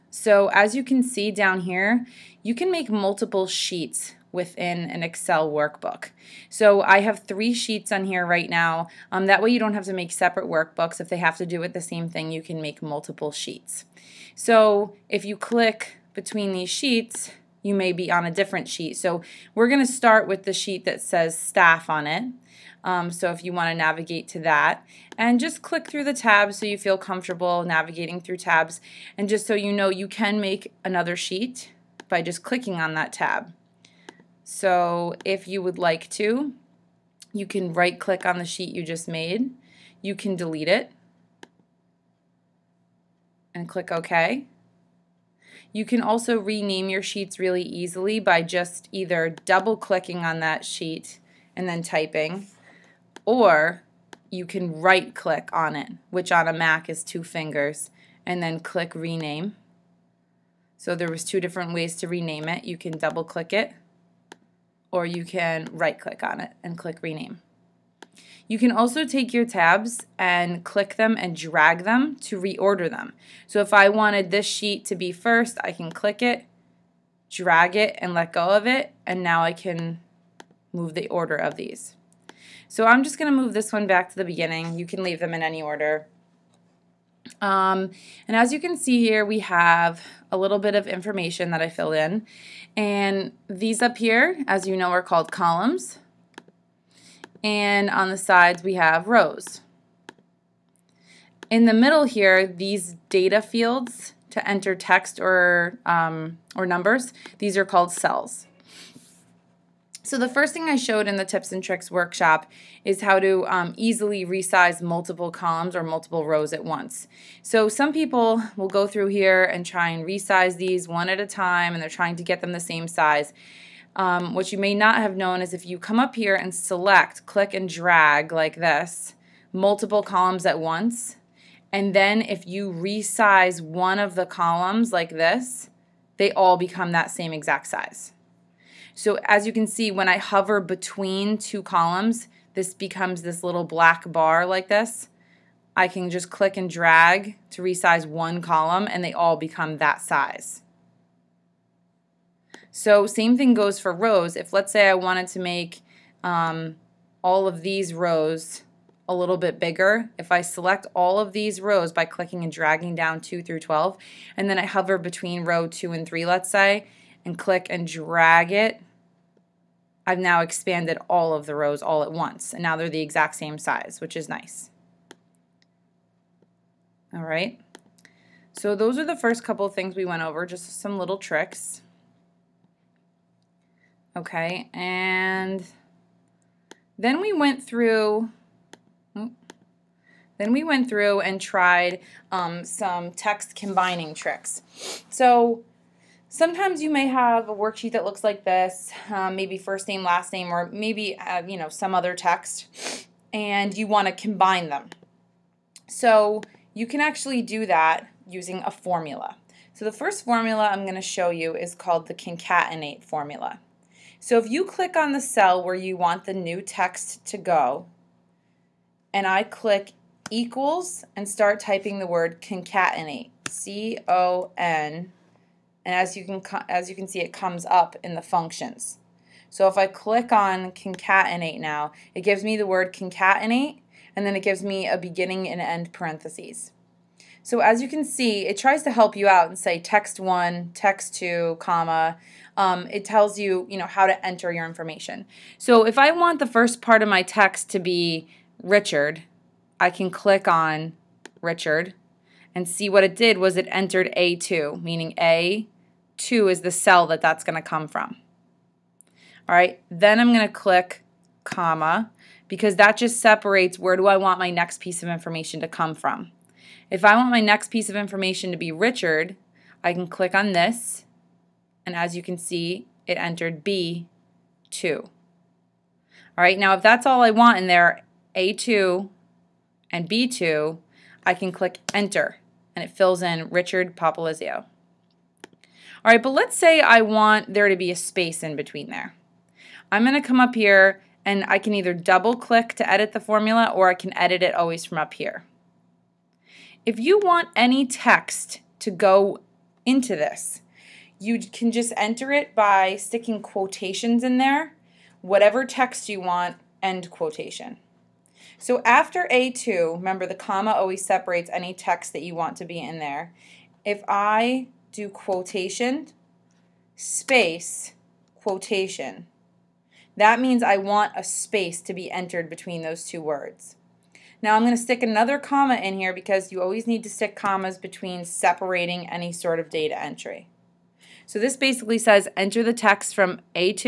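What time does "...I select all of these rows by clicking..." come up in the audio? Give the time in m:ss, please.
2:40.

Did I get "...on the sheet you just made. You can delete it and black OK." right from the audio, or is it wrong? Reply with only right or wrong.
wrong.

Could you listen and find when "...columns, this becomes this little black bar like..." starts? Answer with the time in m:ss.
2:21.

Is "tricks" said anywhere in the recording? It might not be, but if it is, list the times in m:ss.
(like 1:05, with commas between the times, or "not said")
1:51, 3:01, 3:14.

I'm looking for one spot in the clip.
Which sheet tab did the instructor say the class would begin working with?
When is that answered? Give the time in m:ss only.
0:21.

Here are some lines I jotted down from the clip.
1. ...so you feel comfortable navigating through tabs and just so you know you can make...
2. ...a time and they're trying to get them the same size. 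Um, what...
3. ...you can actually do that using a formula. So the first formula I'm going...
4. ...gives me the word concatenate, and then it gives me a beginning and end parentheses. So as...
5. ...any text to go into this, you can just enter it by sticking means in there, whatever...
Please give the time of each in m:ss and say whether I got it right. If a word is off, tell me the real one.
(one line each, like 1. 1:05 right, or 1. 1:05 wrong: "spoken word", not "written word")
1. 0:26 right
2. 2:01 right
3. 3:26 right
4. 3:52 right
5. 4:57 wrong: "quotations", not "means".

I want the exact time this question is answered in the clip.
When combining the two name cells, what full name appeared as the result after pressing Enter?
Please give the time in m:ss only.
4:43.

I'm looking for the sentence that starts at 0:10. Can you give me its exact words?
If they have to do with the same thing, you can make multiple sheets.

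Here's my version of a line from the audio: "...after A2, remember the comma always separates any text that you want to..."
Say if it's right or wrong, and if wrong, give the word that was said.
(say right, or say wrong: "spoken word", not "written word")
right.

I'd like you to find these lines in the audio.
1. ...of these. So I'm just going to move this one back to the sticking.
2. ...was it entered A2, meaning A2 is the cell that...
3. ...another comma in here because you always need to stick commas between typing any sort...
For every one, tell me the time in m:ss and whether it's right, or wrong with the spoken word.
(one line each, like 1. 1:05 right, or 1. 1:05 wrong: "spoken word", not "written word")
1. 1:21 wrong: "beginning", not "sticking"
2. 4:13 right
3. 5:25 wrong: "separating", not "typing".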